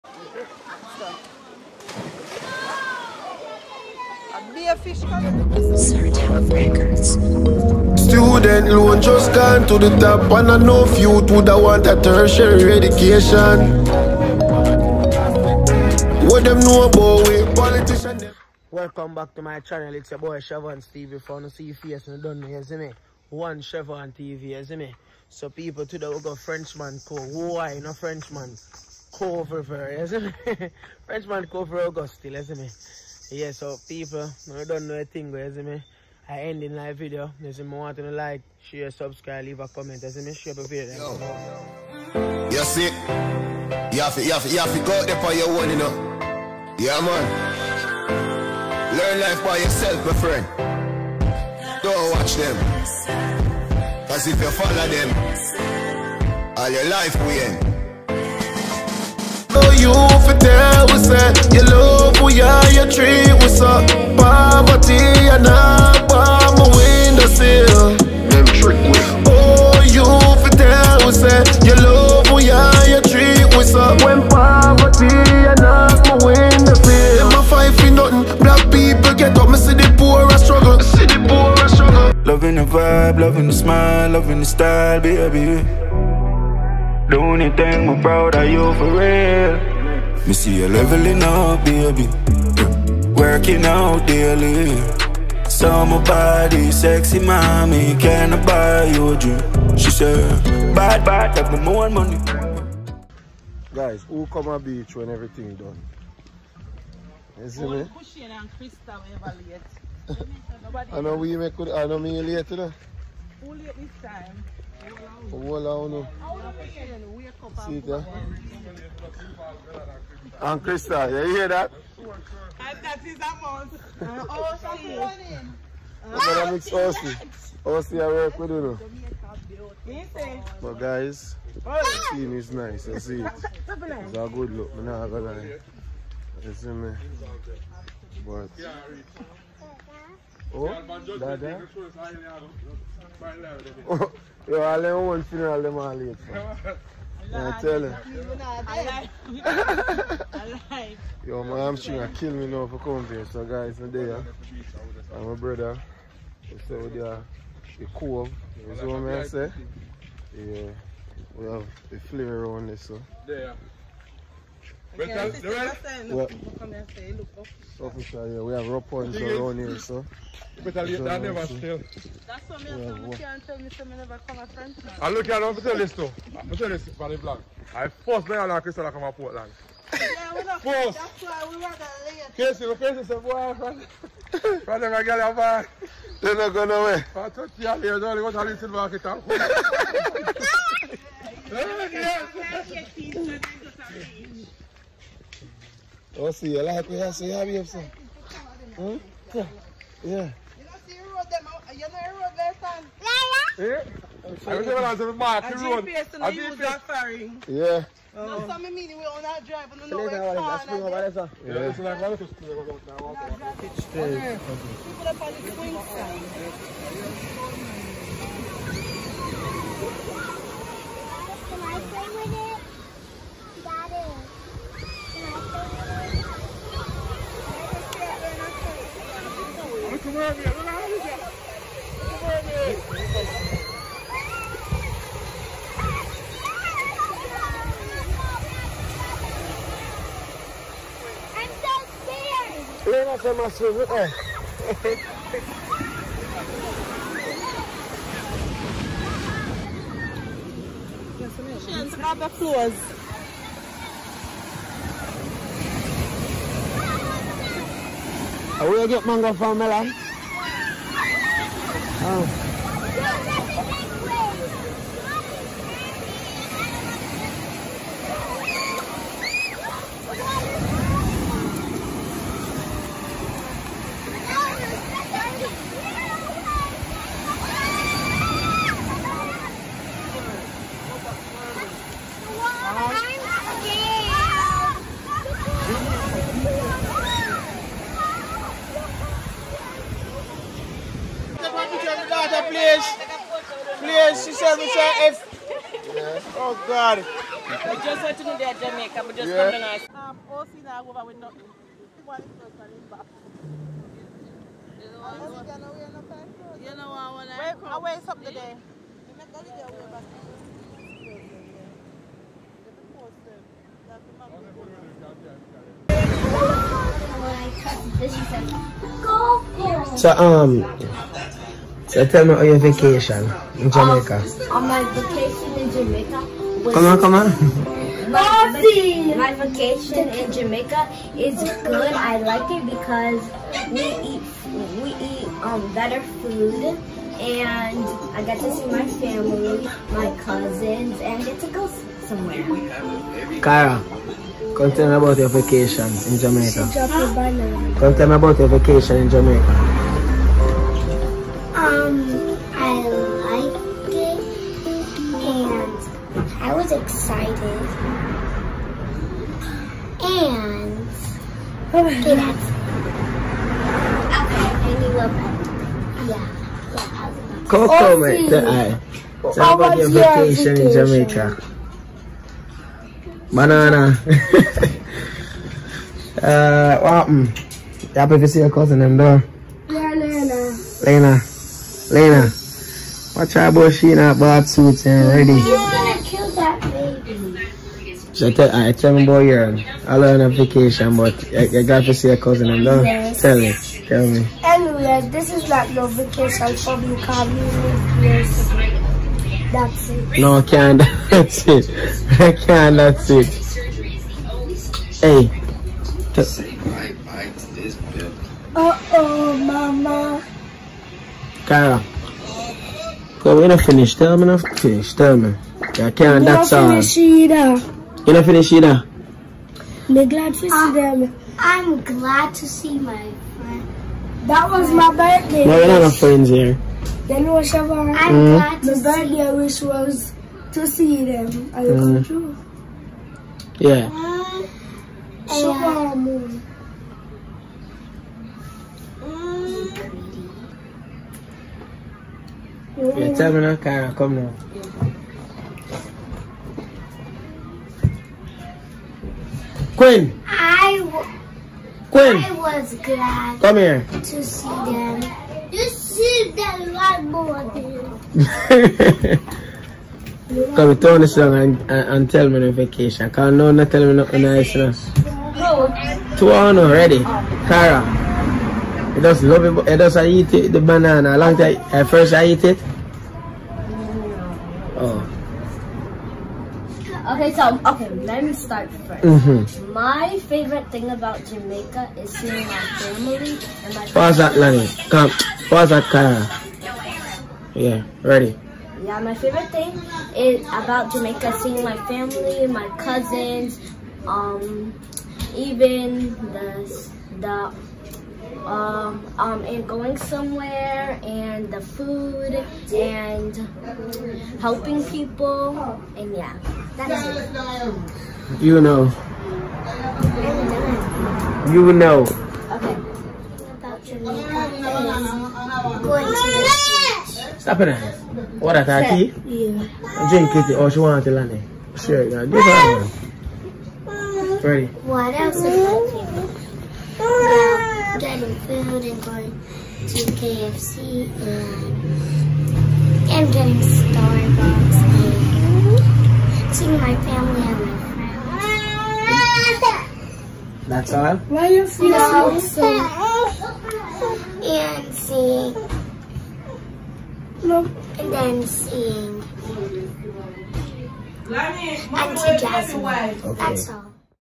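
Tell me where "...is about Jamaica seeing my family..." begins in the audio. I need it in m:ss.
8:10.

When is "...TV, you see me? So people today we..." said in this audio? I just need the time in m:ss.
0:24.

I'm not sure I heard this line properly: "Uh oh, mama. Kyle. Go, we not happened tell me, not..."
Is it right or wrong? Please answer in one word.
wrong.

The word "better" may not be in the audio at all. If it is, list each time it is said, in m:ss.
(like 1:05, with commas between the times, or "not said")
2:50, 5:35.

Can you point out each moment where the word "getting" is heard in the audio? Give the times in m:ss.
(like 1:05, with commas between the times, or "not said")
8:47, 8:53.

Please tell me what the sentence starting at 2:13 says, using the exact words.
It's a good look, I'm not gonna lie.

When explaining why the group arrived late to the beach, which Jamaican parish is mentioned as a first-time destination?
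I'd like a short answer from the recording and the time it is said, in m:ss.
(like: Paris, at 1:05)
Portland, at 2:59.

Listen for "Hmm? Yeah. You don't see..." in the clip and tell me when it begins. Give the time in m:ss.
3:18.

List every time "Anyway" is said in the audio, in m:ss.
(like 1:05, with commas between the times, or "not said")
6:34.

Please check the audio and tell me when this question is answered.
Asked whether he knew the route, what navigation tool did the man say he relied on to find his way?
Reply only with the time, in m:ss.
3:25.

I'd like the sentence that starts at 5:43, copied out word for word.
Kara, come tell me about your vacation in Jamaica.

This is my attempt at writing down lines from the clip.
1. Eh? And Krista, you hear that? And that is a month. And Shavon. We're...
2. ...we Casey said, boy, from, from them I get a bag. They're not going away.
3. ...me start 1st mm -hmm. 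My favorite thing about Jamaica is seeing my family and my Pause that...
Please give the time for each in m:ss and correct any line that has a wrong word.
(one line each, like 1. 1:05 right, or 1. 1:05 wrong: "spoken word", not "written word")
1. 1:57 wrong: "Aussie", not "Shavon"
2. 3:02 right
3. 7:58 right.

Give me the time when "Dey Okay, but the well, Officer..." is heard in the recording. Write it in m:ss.
2:43.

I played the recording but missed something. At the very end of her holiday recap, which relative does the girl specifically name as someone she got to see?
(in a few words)
Auntie Jasmine.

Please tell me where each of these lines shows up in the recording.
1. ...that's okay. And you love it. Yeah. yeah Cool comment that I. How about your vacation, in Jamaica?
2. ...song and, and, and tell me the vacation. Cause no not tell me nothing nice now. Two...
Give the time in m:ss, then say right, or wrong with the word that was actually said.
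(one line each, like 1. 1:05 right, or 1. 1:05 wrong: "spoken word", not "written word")
1. 6:02 right
2. 7:41 right.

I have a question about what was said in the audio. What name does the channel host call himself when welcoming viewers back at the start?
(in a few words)
Shavon Stevie.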